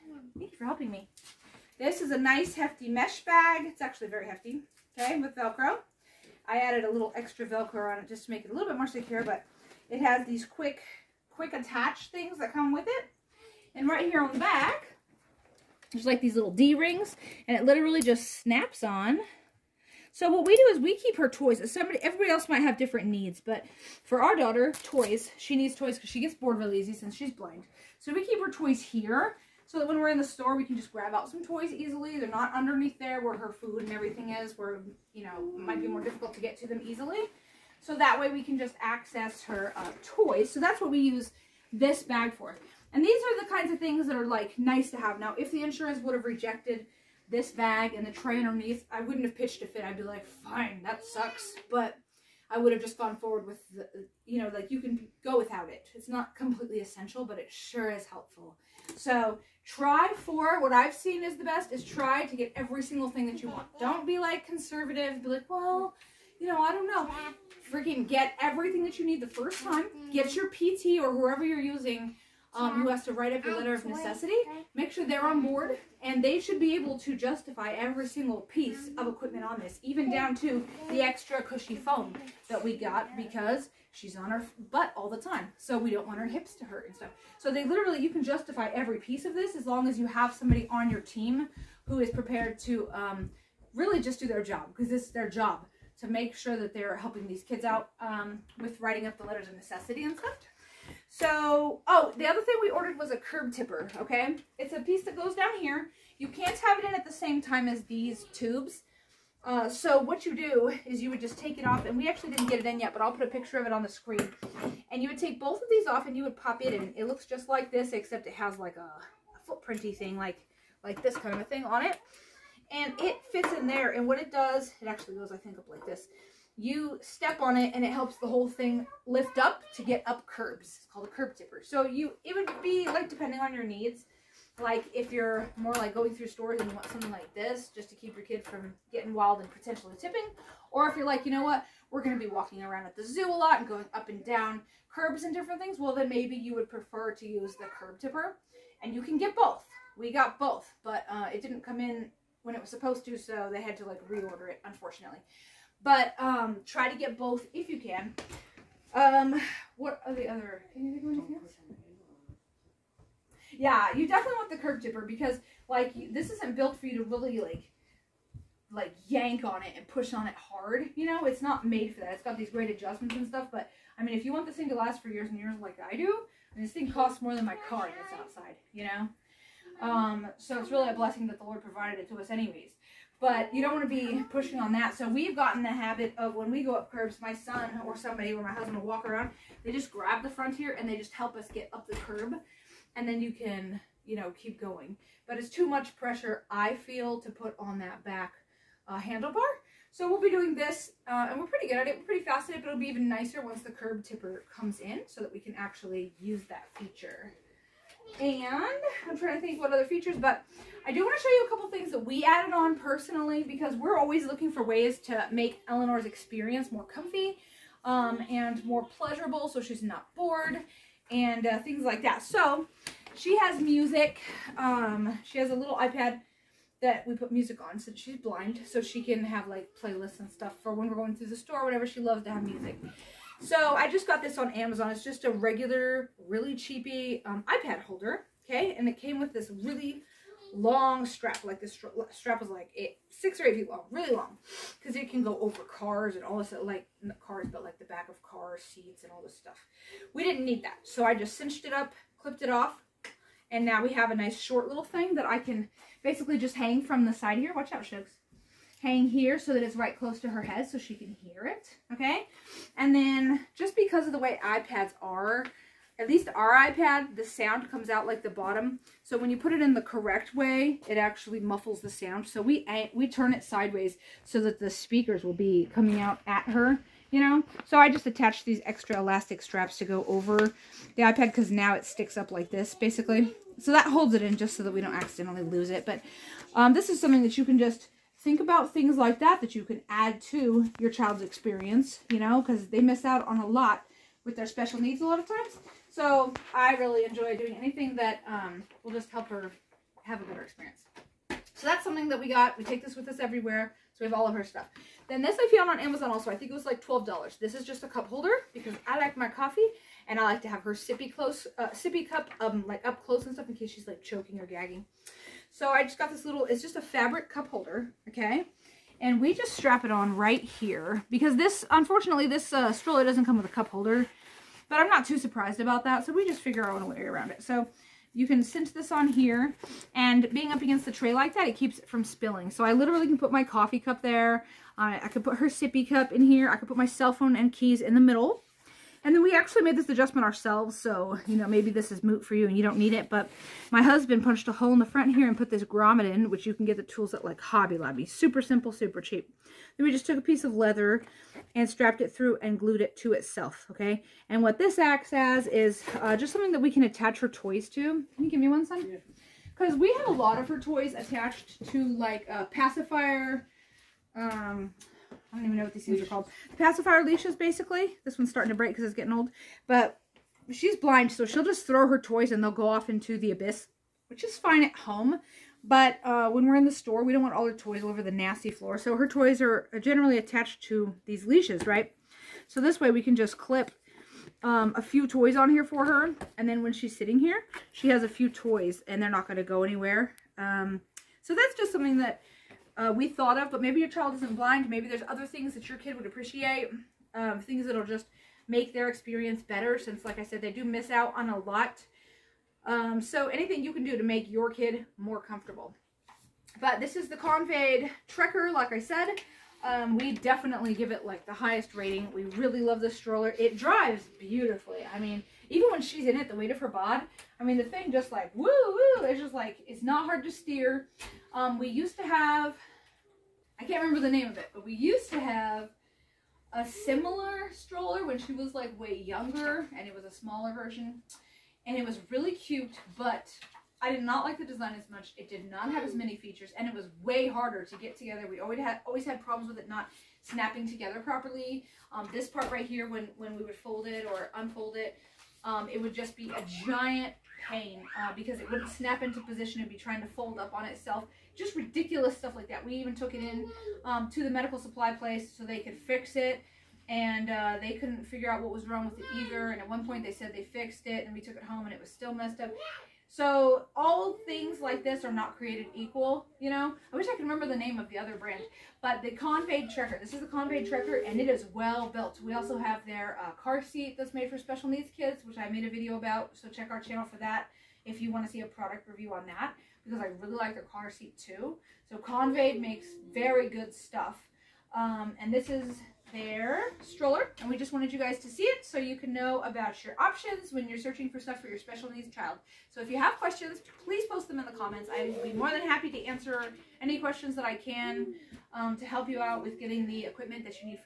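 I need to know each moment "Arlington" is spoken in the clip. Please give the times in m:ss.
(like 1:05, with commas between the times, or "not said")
not said.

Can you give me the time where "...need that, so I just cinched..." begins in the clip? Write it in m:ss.
4:10.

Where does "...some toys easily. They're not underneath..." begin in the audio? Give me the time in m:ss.
0:31.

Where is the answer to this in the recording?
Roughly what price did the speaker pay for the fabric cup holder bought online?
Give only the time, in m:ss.
5:06.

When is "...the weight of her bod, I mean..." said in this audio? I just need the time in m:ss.
6:56.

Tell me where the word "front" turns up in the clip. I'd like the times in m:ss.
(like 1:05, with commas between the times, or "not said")
3:10, 5:44.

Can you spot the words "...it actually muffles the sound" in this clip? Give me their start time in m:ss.
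4:30.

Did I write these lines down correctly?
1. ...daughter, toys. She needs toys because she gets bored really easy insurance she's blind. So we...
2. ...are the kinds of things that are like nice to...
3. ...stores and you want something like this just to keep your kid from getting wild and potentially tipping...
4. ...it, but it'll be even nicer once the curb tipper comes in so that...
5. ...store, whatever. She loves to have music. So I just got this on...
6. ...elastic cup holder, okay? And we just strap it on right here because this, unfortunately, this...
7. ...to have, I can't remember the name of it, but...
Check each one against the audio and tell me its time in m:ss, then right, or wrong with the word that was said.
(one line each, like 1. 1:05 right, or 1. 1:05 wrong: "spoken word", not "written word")
1. 0:24 wrong: "since", not "insurance"
2. 0:43 right
3. 2:16 right
4. 3:22 right
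5. 3:51 right
6. 5:16 wrong: "fabric", not "elastic"
7. 7:01 right.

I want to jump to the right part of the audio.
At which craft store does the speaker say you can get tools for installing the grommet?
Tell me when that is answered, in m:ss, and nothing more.
5:47.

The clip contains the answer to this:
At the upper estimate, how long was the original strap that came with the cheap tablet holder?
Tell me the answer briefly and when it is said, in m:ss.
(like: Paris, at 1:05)
8 feet, at 4:03.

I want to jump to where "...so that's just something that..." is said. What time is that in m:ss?
6:31.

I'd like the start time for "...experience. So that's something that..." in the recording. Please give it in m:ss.
5:00.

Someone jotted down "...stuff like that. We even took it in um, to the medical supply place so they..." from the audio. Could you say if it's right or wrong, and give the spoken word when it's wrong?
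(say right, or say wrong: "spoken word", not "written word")
right.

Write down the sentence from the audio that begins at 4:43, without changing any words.
So that holds it in just so that we don't accidentally lose it.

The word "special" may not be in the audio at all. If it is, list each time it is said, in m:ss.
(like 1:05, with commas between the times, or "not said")
4:54, 7:54, 8:11.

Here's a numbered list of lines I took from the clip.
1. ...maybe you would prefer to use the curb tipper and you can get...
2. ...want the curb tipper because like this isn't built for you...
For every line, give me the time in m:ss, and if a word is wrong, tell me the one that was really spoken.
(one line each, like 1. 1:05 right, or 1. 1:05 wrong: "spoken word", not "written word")
1. 2:26 right
2. 2:44 right.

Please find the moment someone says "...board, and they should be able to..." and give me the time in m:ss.
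1:15.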